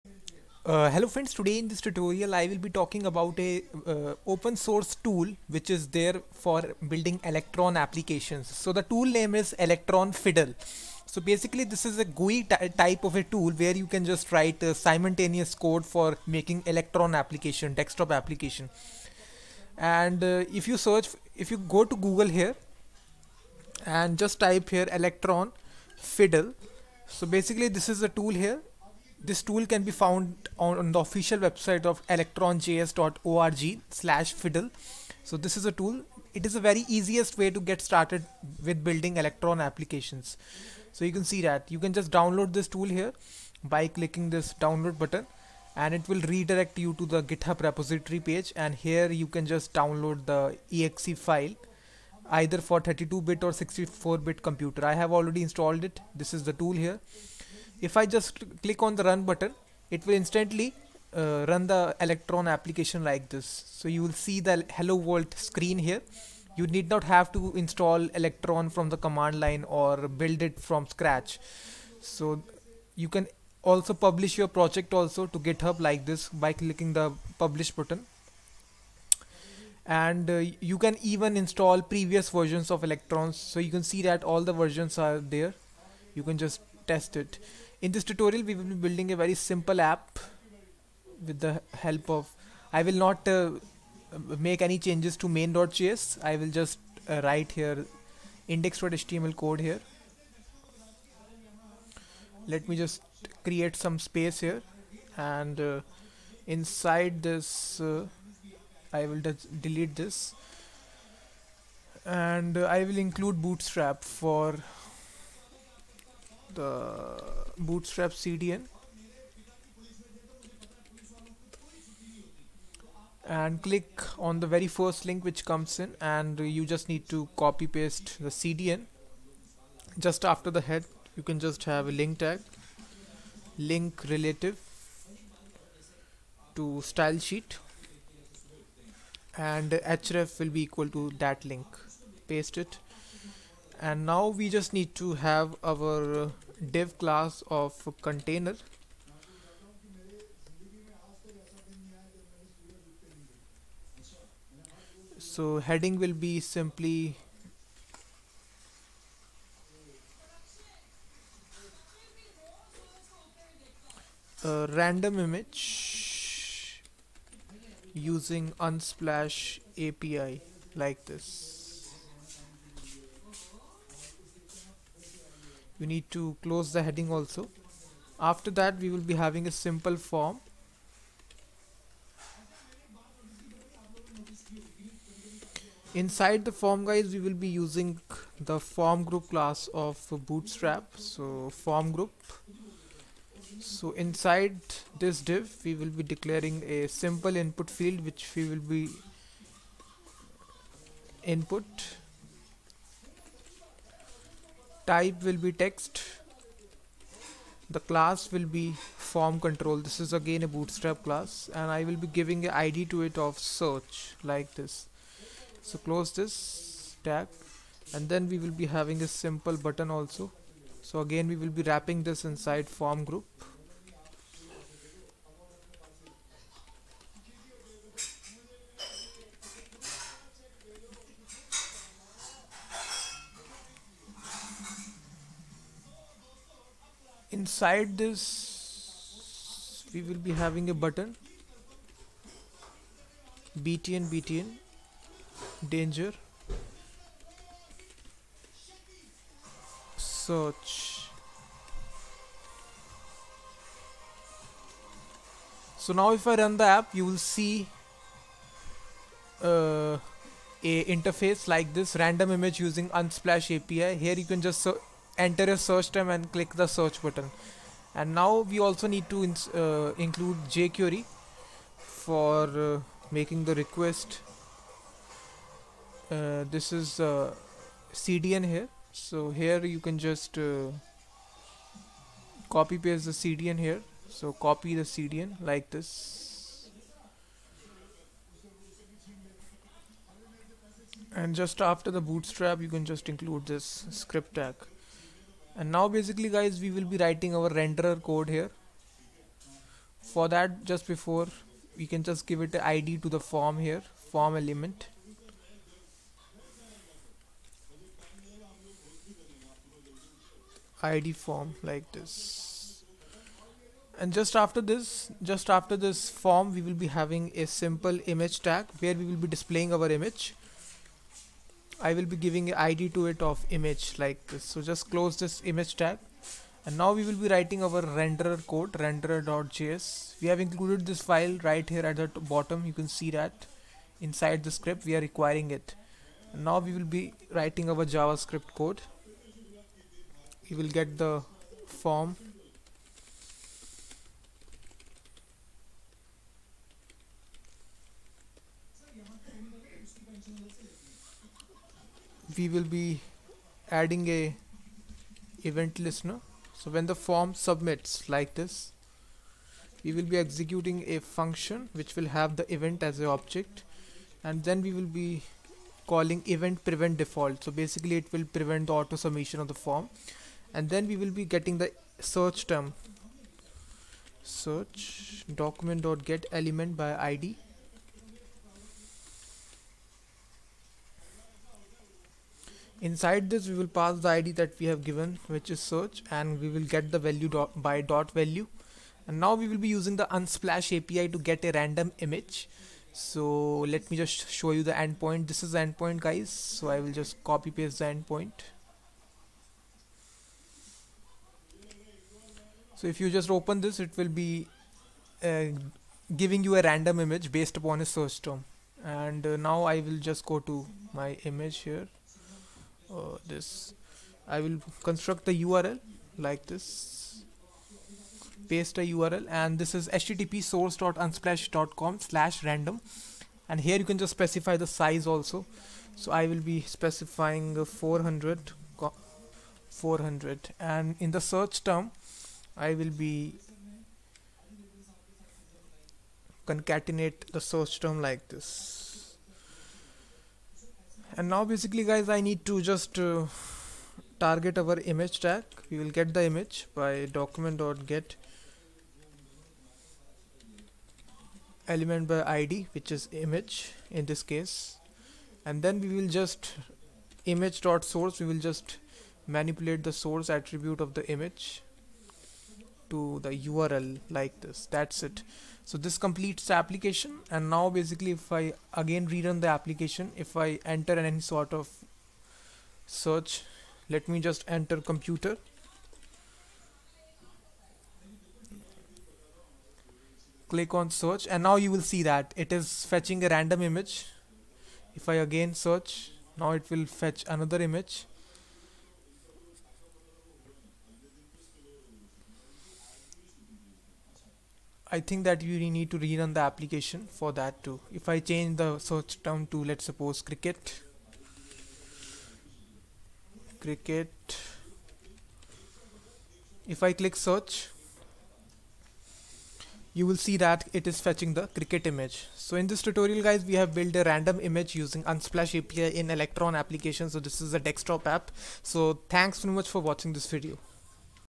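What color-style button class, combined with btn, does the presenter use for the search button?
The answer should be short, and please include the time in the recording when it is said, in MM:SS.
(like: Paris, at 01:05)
btn danger, at 04:04.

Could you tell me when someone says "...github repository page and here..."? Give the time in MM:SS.
00:47.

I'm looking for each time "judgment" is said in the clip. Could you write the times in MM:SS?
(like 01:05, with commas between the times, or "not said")
not said.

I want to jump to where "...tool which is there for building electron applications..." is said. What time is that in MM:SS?
00:04.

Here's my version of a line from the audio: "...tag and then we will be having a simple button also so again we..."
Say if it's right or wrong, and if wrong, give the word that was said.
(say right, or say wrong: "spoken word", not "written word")
right.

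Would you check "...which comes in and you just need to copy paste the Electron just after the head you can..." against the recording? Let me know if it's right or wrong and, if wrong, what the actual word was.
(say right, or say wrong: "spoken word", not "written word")
wrong: "CDN", not "Electron".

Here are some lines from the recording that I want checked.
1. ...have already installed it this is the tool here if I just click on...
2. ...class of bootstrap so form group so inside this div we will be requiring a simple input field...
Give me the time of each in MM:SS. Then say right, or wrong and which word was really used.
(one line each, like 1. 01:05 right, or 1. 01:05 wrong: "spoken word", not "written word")
1. 00:54 right
2. 03:09 wrong: "declaring", not "requiring".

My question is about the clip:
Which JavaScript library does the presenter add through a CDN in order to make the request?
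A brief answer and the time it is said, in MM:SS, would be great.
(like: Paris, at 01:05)
jQuery, at 04:30.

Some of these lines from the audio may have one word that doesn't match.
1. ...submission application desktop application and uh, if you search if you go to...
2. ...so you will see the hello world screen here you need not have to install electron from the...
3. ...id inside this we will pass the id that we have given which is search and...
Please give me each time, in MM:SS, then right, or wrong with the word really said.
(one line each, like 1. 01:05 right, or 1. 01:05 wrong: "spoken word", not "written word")
1. 00:16 wrong: "electron", not "submission"
2. 01:03 right
3. 06:17 right.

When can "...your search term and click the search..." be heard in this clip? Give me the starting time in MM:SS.
04:25.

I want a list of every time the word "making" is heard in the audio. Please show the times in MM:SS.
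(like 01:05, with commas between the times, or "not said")
00:16, 04:33.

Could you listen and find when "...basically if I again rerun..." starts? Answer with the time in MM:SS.
07:47.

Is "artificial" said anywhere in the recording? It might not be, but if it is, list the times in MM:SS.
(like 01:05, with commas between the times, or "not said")
not said.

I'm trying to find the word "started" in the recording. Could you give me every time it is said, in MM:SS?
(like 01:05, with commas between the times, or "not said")
00:37.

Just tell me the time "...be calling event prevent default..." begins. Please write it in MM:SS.
06:04.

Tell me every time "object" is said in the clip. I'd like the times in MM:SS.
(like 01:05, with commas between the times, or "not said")
06:03.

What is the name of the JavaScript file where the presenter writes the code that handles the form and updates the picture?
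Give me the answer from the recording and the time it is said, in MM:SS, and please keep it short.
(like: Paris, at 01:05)
renderer.js, at 05:28.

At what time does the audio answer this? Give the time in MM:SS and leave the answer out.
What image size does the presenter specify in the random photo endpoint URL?
07:07.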